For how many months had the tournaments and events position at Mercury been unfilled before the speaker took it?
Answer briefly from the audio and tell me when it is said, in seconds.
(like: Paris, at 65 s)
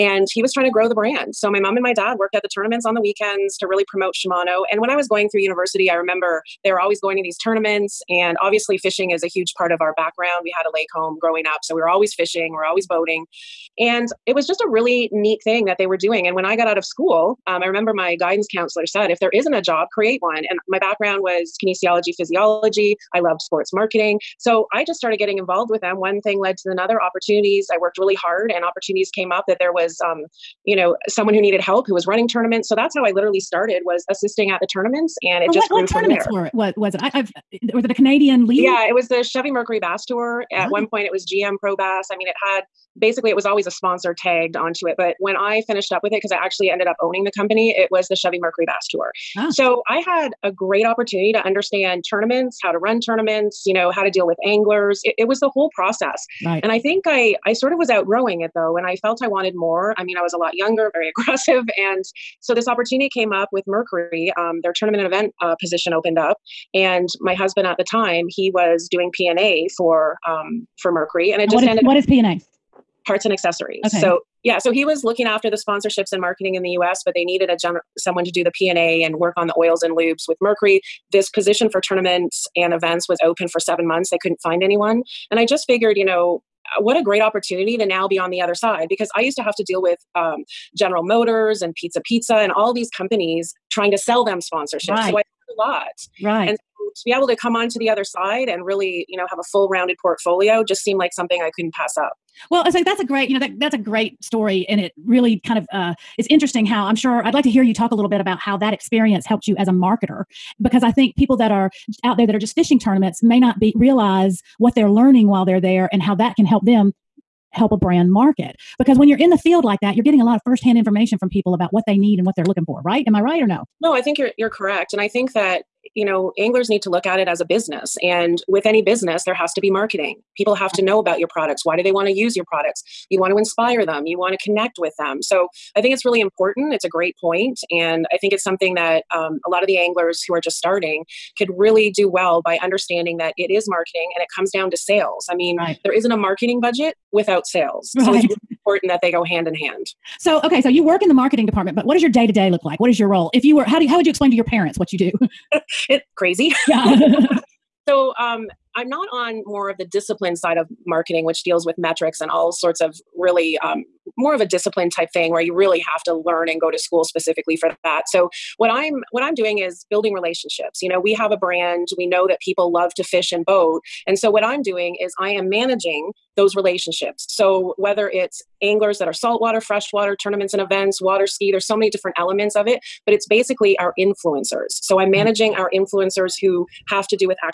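7, at 83 s.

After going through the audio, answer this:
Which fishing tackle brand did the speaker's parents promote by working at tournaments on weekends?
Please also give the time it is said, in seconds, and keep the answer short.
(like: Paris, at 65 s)
Shimano, at 4 s.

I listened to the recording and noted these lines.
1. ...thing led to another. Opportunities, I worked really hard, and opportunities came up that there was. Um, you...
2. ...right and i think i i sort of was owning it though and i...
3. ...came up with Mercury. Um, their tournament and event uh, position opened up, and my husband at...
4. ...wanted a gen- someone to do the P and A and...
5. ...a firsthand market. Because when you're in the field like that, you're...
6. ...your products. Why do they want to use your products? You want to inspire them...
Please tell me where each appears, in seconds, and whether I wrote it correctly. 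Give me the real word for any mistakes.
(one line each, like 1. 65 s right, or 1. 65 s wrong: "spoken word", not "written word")
1. 26 s right
2. 56 s wrong: "outgrowing", not "owning"
3. 63 s right
4. 77 s wrong: "needed", not "wanted"
5. 117 s wrong: "brand", not "firsthand"
6. 131 s right.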